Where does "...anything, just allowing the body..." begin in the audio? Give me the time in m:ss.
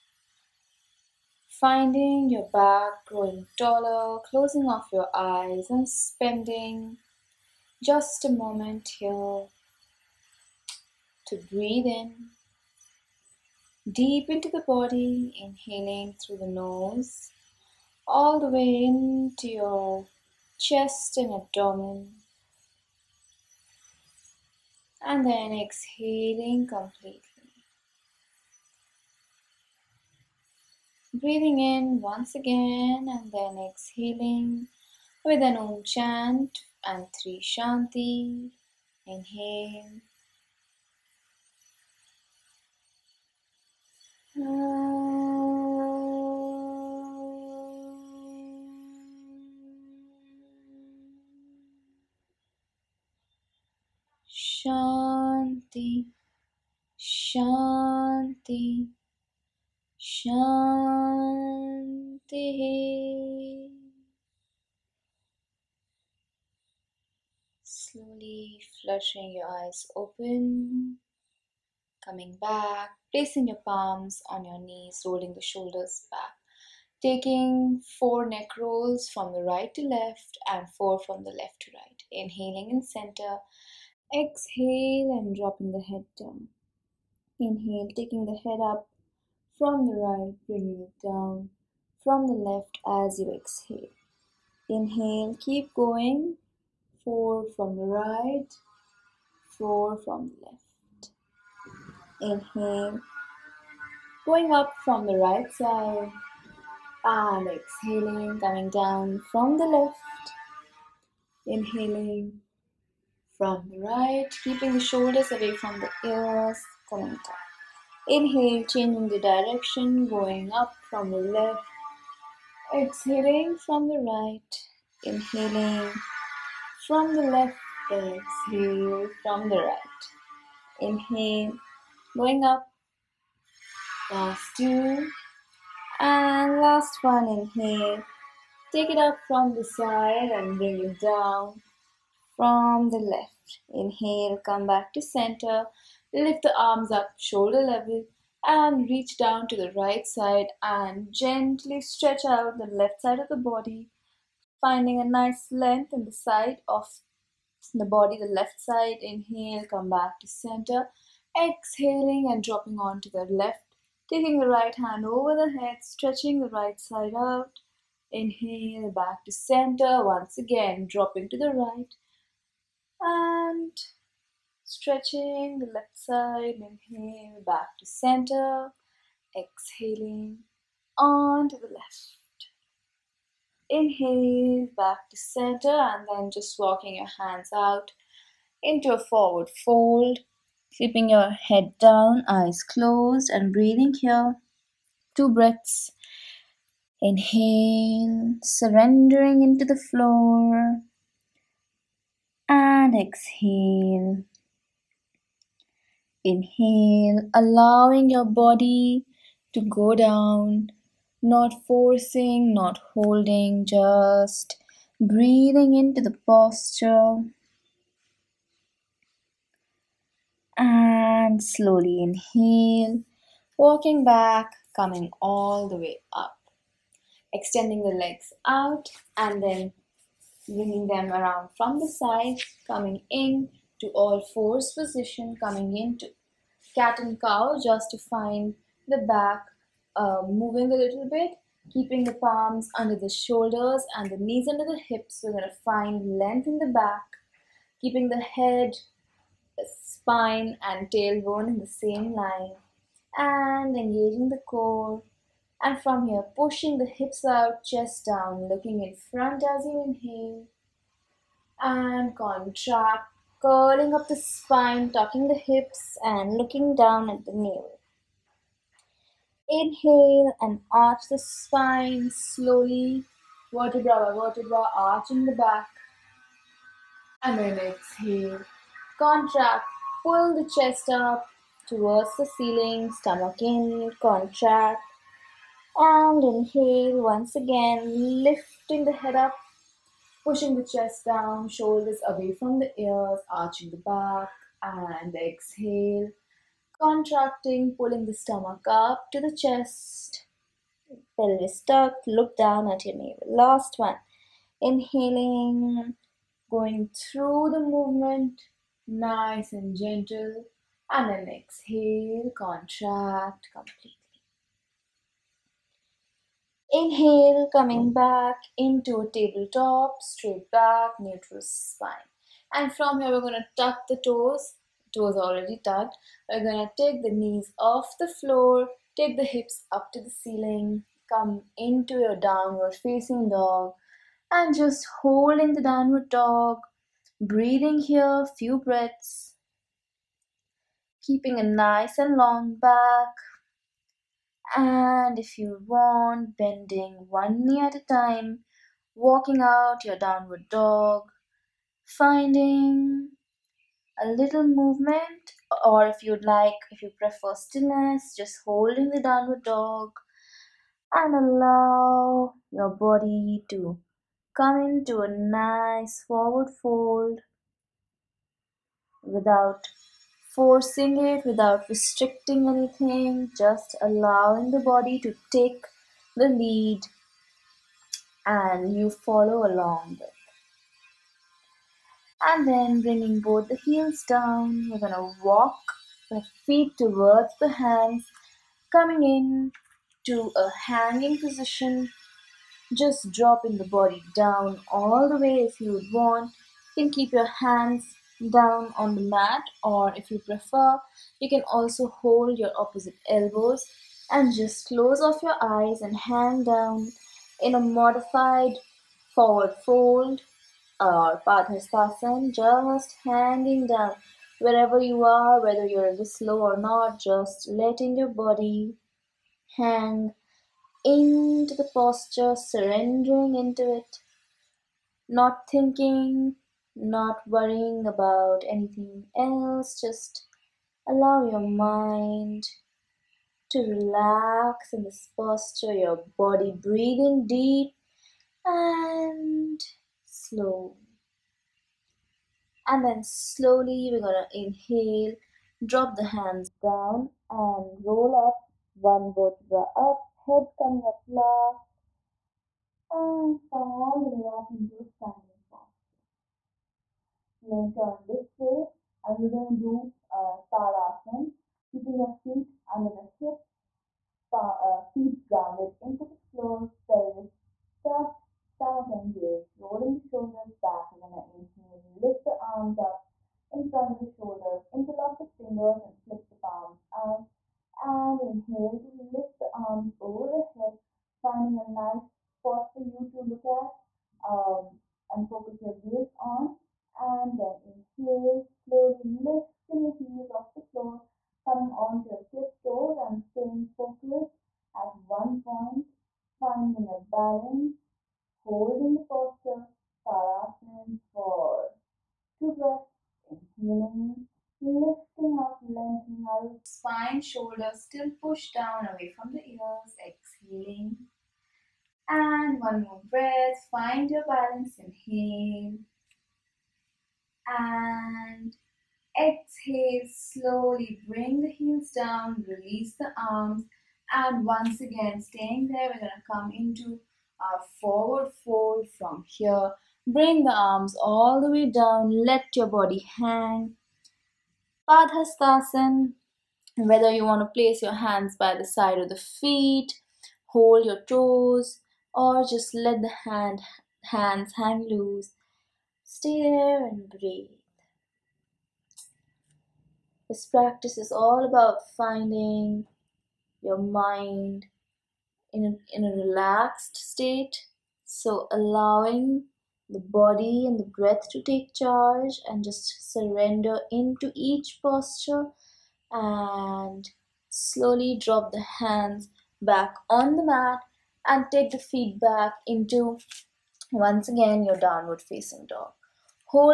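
6:12.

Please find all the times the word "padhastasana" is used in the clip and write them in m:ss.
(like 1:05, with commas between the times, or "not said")
8:54.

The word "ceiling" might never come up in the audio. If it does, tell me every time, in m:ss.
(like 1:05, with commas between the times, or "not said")
4:42, 5:30.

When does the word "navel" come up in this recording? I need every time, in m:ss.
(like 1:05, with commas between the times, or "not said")
4:27, 5:02.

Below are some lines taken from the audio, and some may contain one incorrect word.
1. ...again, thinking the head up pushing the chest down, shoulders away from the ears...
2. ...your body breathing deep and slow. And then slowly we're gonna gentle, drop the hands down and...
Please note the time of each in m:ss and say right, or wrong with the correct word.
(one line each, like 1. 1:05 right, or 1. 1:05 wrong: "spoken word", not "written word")
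1. 4:47 wrong: "lifting", not "thinking"
2. 7:15 wrong: "inhale", not "gentle".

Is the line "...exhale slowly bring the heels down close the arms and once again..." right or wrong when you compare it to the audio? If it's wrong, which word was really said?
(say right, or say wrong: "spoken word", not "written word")
wrong: "release", not "close".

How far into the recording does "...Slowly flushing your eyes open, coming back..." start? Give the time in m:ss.
1:07.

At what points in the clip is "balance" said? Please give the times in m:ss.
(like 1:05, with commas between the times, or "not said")
8:17, 8:34.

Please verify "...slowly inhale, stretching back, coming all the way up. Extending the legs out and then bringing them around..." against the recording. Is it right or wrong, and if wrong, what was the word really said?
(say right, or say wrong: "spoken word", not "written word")
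wrong: "walking", not "stretching".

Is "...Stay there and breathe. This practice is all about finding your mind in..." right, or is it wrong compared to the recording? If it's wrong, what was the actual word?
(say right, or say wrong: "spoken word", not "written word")
right.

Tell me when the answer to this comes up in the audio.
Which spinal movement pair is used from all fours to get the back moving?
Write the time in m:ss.
3:56.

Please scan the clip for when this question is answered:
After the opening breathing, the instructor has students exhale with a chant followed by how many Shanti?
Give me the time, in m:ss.
0:37.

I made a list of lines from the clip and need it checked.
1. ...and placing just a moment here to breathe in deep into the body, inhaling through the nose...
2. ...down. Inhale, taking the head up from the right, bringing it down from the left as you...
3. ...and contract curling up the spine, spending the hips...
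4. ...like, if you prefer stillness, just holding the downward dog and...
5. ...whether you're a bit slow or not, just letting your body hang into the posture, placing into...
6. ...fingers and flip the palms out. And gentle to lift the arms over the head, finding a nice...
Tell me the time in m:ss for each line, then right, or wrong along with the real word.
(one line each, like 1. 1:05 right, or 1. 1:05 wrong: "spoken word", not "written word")
1. 0:05 wrong: "spending", not "placing"
2. 1:26 right
3. 4:21 wrong: "tucking", not "spending"
4. 5:56 right
5. 6:55 wrong: "surrendering", not "placing"
6. 7:55 wrong: "inhale", not "gentle".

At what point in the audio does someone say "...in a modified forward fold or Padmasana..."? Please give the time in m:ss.
6:47.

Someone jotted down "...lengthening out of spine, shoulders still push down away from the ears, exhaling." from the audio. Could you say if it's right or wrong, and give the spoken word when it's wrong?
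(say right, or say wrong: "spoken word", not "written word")
right.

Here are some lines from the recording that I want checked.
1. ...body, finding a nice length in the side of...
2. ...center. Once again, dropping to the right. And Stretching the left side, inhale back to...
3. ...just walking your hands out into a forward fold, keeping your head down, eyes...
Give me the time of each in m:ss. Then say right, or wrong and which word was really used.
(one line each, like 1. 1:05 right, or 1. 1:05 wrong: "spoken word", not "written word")
1. 2:33 right
2. 2:49 right
3. 3:06 right.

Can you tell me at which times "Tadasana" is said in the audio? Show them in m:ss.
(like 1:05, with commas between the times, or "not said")
7:40, 8:20.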